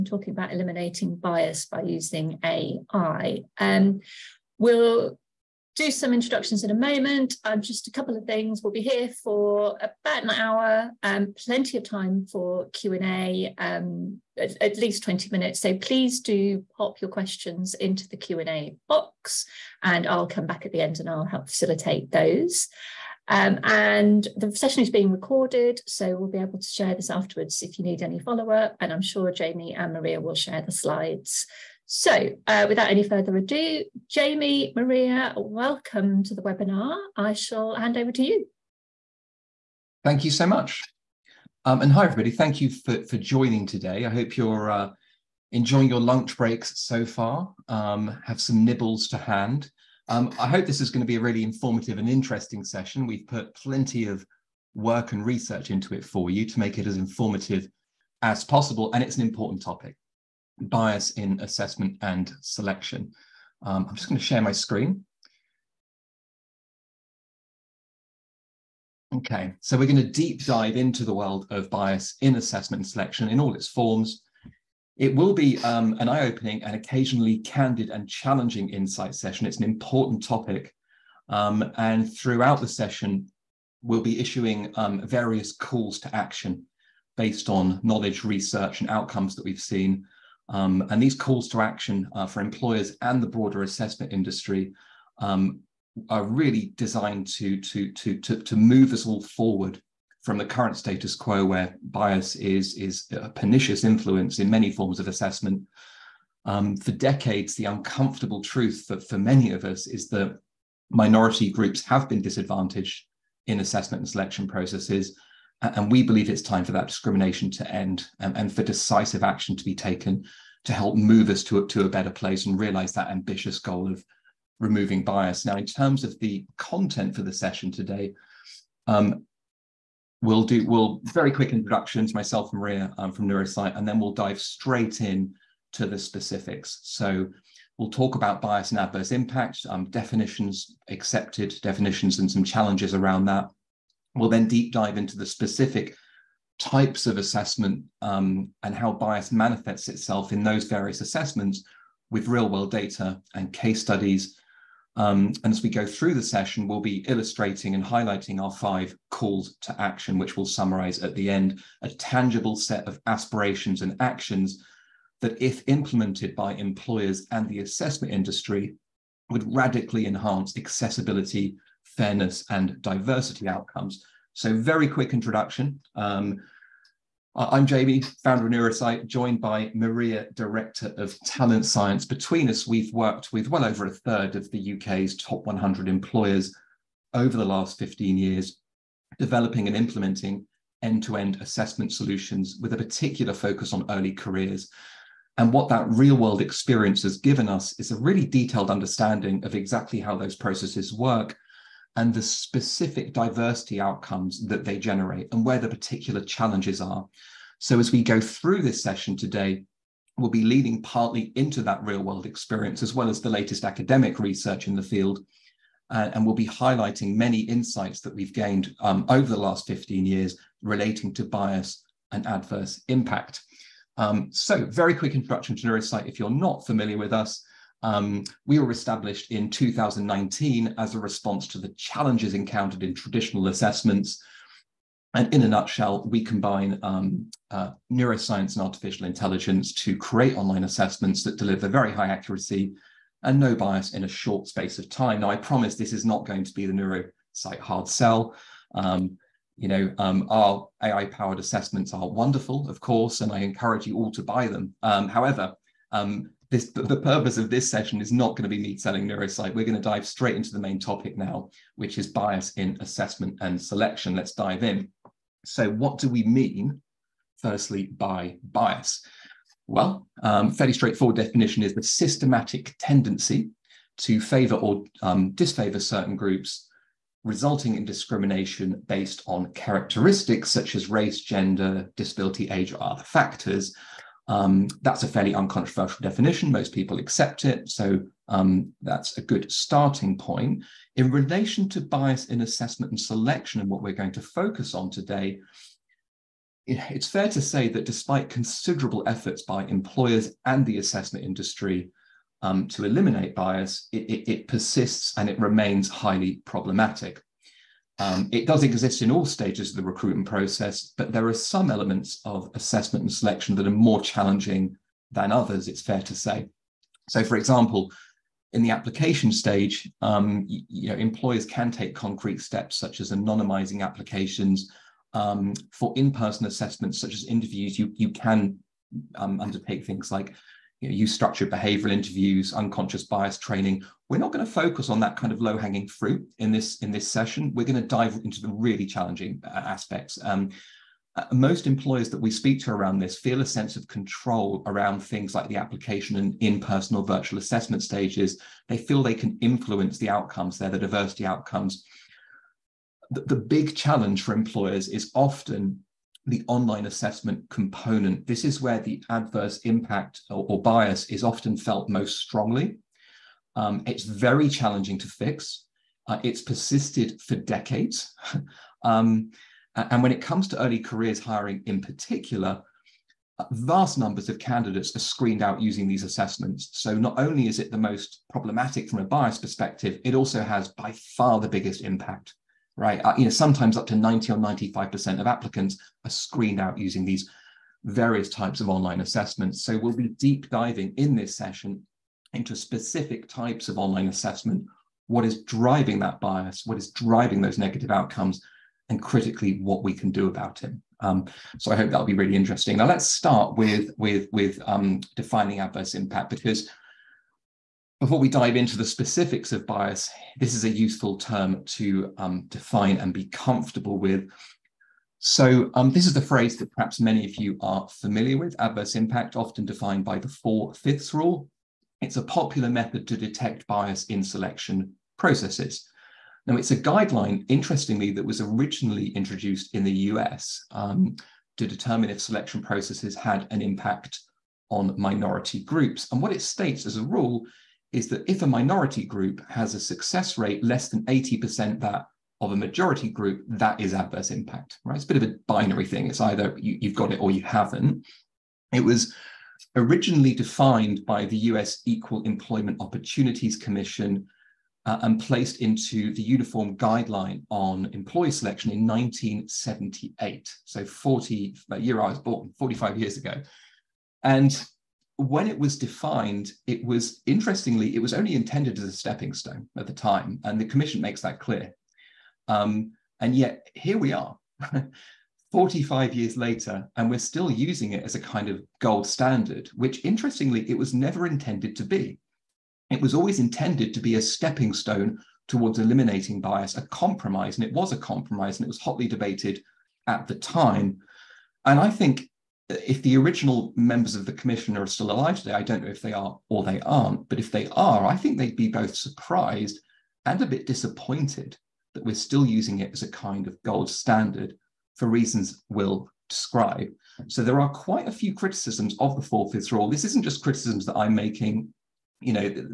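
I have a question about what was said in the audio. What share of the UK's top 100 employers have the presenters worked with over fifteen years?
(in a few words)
Over a third.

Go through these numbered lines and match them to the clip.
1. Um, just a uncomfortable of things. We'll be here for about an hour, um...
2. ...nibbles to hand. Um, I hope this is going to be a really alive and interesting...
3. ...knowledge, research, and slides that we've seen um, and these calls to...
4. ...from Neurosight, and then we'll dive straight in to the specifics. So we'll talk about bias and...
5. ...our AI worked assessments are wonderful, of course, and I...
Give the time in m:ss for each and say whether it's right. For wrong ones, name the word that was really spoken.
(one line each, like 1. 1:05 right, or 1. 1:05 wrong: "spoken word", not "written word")
1. 0:07 wrong: "couple", not "uncomfortable"
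2. 0:48 wrong: "informative", not "alive"
3. 1:27 wrong: "outcomes", not "slides"
4. 2:13 right
5. 4:10 wrong: "powered", not "worked".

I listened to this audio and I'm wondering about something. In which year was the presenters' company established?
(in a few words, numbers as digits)
2019.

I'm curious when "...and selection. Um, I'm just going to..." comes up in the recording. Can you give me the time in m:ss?
1:02.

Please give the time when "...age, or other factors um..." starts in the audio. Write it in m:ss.
4:42.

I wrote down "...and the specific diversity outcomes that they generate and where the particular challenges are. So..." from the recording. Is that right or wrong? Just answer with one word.
right.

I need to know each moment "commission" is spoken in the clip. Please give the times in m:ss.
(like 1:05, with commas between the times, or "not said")
7:33, 7:50, 8:14.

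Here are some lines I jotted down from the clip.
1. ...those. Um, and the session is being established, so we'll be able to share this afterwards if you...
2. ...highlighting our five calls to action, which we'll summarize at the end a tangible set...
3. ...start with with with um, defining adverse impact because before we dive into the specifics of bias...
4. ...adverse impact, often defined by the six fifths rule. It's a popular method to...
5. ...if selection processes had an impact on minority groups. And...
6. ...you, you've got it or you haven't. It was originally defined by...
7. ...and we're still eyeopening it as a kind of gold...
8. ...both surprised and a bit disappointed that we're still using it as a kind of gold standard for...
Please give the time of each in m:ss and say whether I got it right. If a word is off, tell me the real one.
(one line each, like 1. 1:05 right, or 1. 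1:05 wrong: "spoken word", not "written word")
1. 0:22 wrong: "recorded", not "established"
2. 2:37 right
3. 6:43 right
4. 6:58 wrong: "four", not "six"
5. 7:12 right
6. 7:26 right
7. 7:56 wrong: "using", not "eyeopening"
8. 8:18 right.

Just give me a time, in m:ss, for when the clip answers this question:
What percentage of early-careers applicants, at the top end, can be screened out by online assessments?
6:24.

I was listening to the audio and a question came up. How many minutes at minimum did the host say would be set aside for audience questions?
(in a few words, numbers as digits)
20.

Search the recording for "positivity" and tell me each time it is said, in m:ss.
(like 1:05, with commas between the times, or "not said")
not said.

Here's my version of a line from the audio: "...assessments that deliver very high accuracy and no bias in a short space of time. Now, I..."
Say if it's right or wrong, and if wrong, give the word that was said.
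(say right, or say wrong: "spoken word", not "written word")
right.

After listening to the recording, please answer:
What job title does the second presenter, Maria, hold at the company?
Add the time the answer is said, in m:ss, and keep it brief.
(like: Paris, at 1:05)
Director of talent science, at 3:00.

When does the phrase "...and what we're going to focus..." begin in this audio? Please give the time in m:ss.
4:53.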